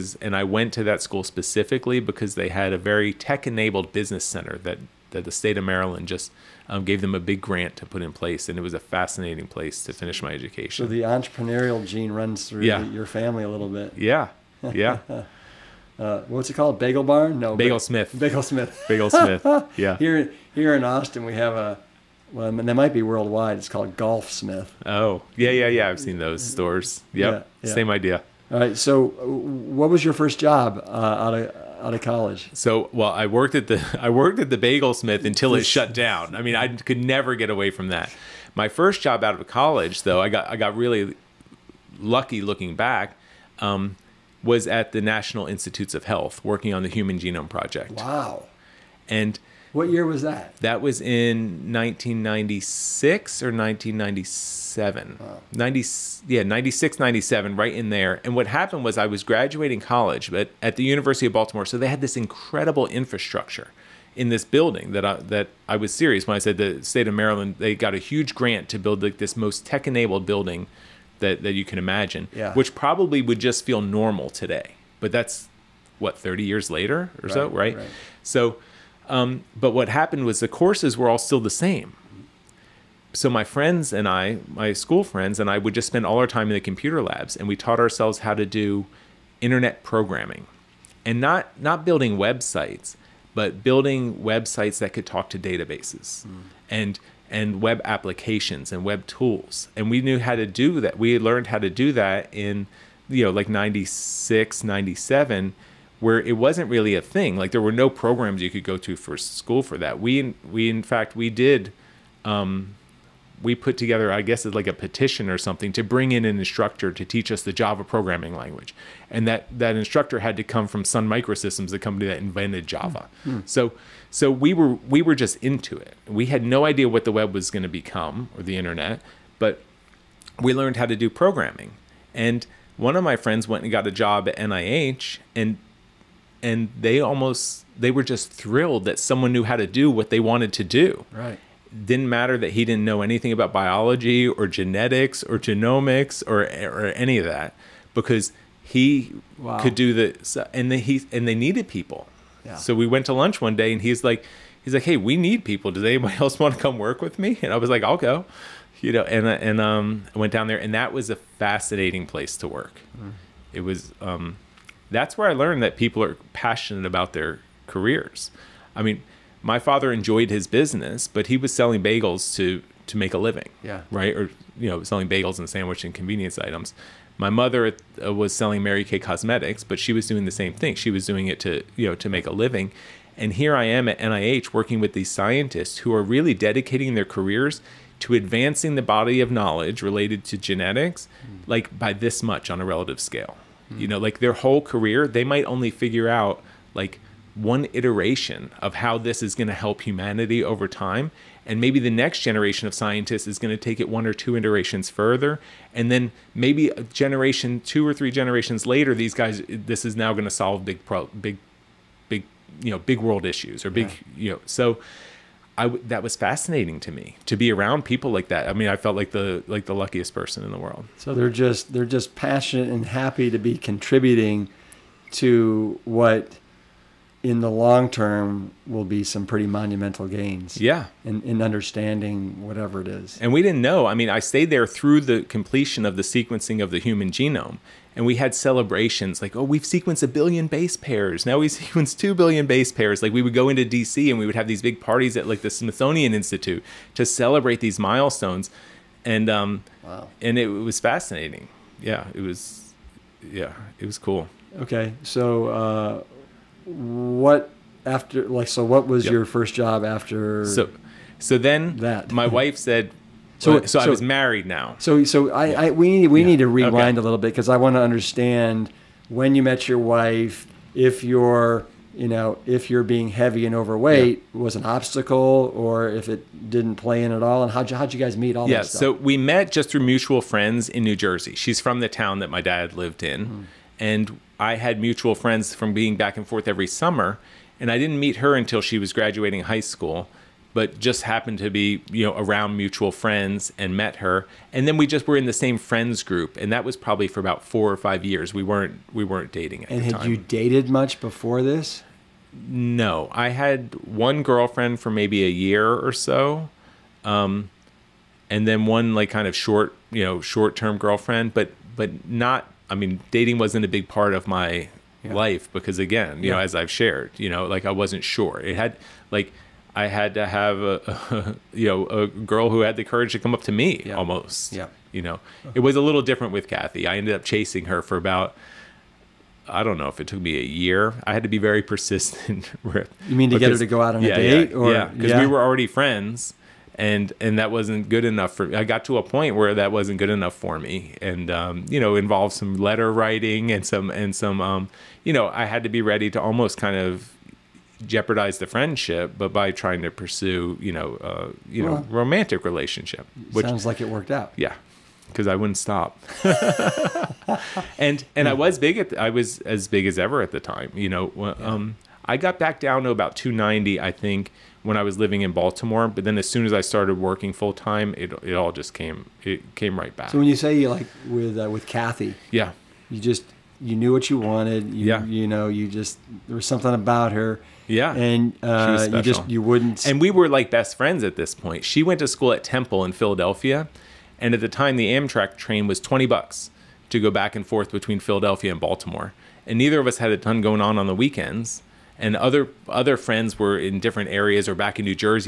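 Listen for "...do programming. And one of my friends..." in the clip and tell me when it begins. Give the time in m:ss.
2:10.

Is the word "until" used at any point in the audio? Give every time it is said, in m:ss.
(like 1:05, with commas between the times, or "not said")
0:35, 4:48.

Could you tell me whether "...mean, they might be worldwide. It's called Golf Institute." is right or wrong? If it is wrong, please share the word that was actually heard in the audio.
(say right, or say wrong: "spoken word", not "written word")
wrong: "Smith", not "Institute".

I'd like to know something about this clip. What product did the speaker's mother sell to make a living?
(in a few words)
Mary Kay Cosmetics.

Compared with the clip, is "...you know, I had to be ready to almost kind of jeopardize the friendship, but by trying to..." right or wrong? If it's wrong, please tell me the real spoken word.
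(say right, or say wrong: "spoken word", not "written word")
right.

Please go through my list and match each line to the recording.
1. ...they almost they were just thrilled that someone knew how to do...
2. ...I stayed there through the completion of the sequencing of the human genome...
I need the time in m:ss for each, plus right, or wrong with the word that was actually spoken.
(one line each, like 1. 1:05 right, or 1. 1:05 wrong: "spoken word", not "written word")
1. 2:16 right
2. 3:54 right.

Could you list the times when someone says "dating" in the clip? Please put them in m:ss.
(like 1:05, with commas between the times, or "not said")
4:59, 5:13.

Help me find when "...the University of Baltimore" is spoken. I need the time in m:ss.
1:00.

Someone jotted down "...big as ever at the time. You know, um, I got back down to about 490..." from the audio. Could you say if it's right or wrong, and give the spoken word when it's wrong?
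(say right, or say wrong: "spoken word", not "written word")
wrong: "290", not "490".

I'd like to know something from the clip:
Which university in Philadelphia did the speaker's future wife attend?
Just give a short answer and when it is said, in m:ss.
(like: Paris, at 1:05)
Temple, at 6:22.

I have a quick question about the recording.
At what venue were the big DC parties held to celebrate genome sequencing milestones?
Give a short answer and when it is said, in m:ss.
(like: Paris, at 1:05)
Smithsonian Institute, at 4:05.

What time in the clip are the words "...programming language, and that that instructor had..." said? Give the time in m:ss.
1:57.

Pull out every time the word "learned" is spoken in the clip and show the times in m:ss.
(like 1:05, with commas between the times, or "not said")
1:41, 2:10, 2:45.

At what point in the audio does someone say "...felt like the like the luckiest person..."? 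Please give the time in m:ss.
3:38.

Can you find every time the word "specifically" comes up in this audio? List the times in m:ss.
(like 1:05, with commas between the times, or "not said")
0:01.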